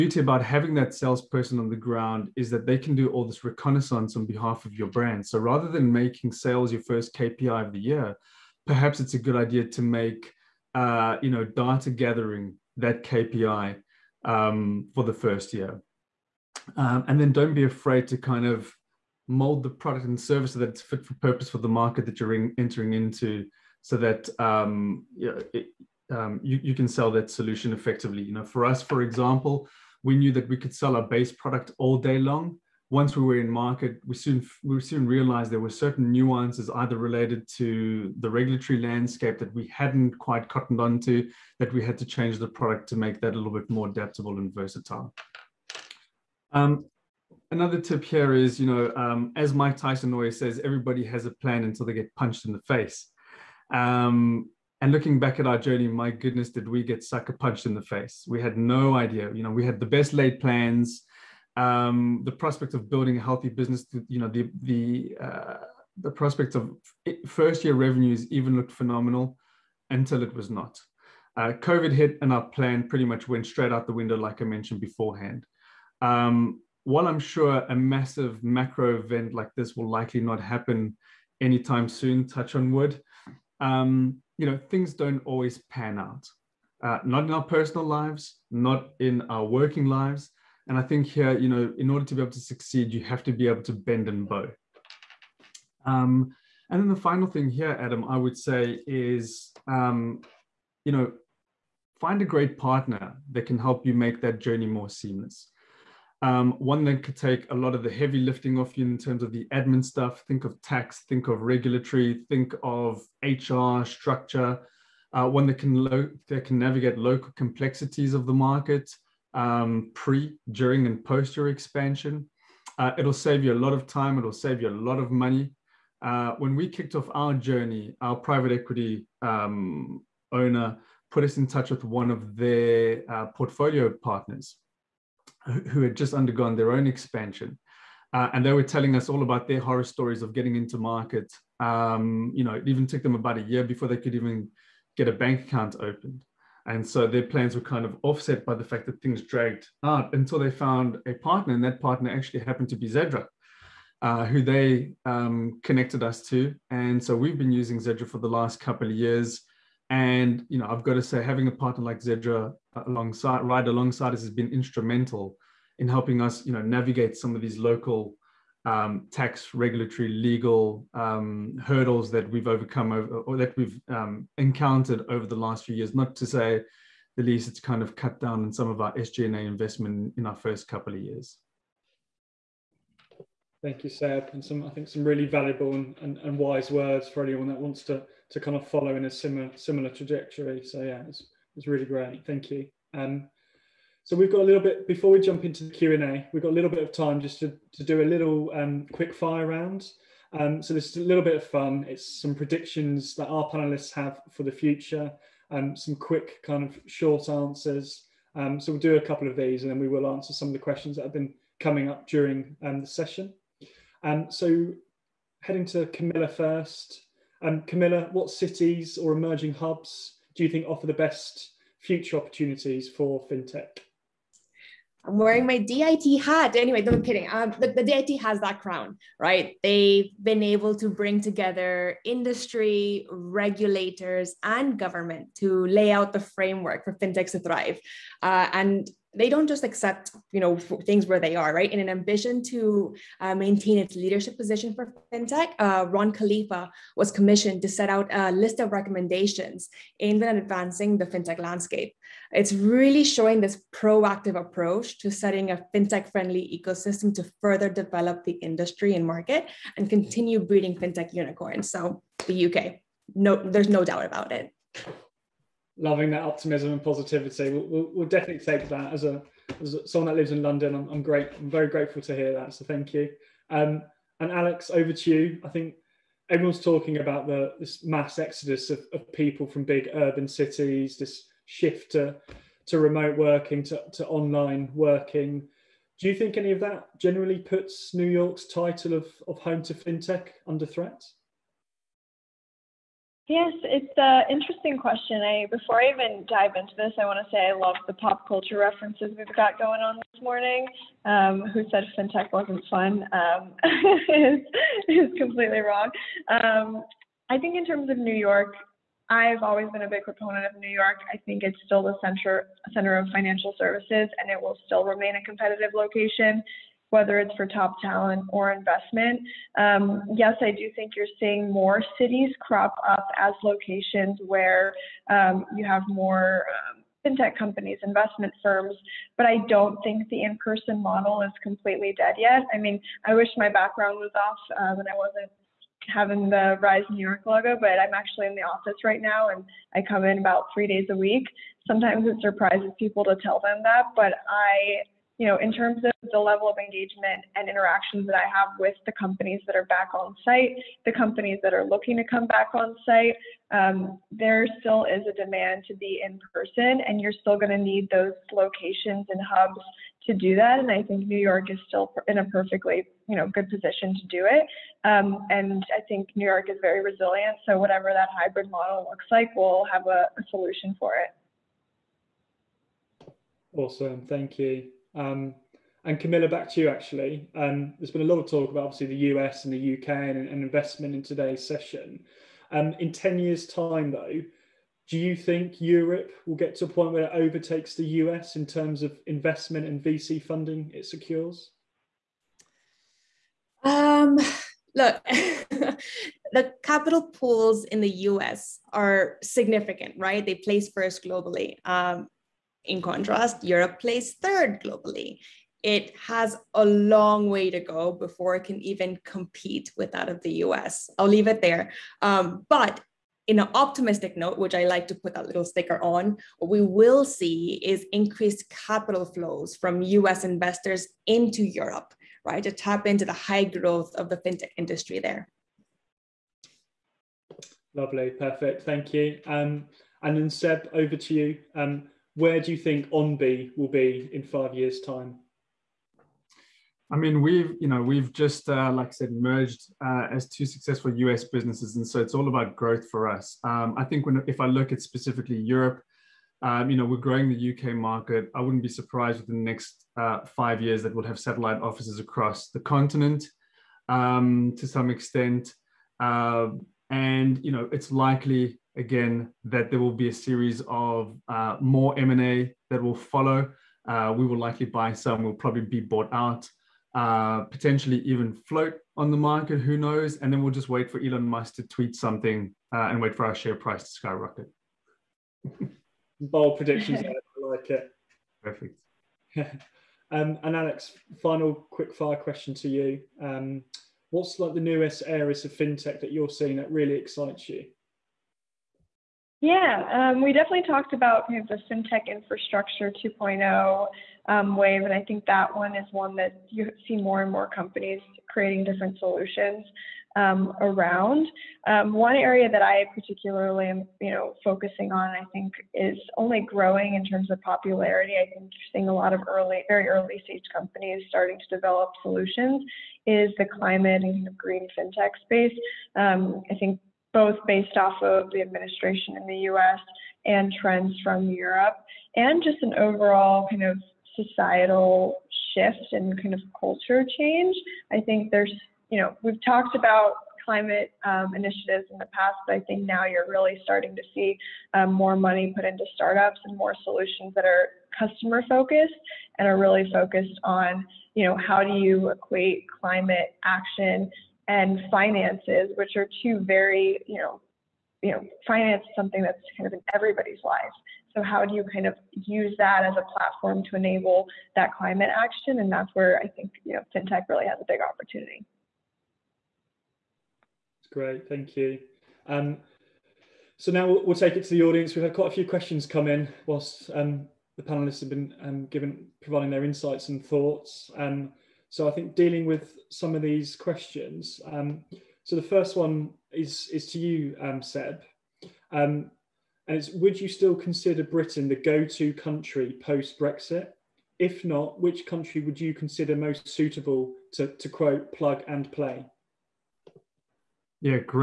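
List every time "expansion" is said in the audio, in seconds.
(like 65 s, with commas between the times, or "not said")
121 s, 136 s.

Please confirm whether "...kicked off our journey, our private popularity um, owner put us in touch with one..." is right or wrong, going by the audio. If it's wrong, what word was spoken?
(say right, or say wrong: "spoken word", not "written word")
wrong: "equity", not "popularity".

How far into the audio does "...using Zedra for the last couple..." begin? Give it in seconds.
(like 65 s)
157 s.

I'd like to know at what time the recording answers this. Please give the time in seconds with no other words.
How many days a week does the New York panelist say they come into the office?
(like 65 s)
340 s.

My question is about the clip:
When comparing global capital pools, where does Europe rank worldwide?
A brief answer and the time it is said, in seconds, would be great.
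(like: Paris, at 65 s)
third, at 404 s.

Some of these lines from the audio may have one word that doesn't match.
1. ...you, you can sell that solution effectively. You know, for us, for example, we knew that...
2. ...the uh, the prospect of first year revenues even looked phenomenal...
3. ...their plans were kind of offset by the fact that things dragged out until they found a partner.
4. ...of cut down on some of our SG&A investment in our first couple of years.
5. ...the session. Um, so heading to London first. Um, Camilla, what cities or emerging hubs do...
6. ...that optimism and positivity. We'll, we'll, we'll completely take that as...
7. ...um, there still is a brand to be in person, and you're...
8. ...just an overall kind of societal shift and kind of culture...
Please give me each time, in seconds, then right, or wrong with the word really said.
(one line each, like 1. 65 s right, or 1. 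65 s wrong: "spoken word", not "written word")
1. 26 s right
2. 64 s right
3. 147 s right
4. 177 s right
5. 212 s wrong: "Camilla", not "London"
6. 266 s wrong: "definitely", not "completely"
7. 353 s wrong: "demand", not "brand"
8. 522 s right.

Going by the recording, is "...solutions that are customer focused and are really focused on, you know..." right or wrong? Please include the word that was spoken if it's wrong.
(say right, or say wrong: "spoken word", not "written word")
right.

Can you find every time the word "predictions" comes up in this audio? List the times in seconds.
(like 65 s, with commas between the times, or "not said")
202 s, 476 s.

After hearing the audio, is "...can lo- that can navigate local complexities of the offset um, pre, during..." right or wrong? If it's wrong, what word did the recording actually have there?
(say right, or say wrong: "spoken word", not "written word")
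wrong: "market", not "offset".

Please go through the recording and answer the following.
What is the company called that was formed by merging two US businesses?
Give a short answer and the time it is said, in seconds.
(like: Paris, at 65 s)
Onbe, at 432 s.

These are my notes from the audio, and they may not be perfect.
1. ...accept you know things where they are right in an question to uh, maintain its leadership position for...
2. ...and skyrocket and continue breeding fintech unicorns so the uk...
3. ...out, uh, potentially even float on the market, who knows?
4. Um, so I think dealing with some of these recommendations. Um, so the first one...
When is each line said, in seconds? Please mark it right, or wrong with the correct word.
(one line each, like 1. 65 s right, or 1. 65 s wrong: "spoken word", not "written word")
1. 239 s wrong: "ambition", not "question"
2. 258 s wrong: "market", not "skyrocket"
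3. 466 s right
4. 570 s wrong: "questions", not "recommendations".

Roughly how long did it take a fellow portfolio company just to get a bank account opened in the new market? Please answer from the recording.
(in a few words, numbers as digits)
about a year.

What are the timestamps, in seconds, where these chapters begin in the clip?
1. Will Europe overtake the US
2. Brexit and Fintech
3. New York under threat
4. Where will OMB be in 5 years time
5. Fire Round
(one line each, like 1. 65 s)
1. 373 s
2. 560 s
3. 265 s
4. 427 s
5. 183 s.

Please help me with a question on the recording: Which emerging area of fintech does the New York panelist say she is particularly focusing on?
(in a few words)
climate and green fintech.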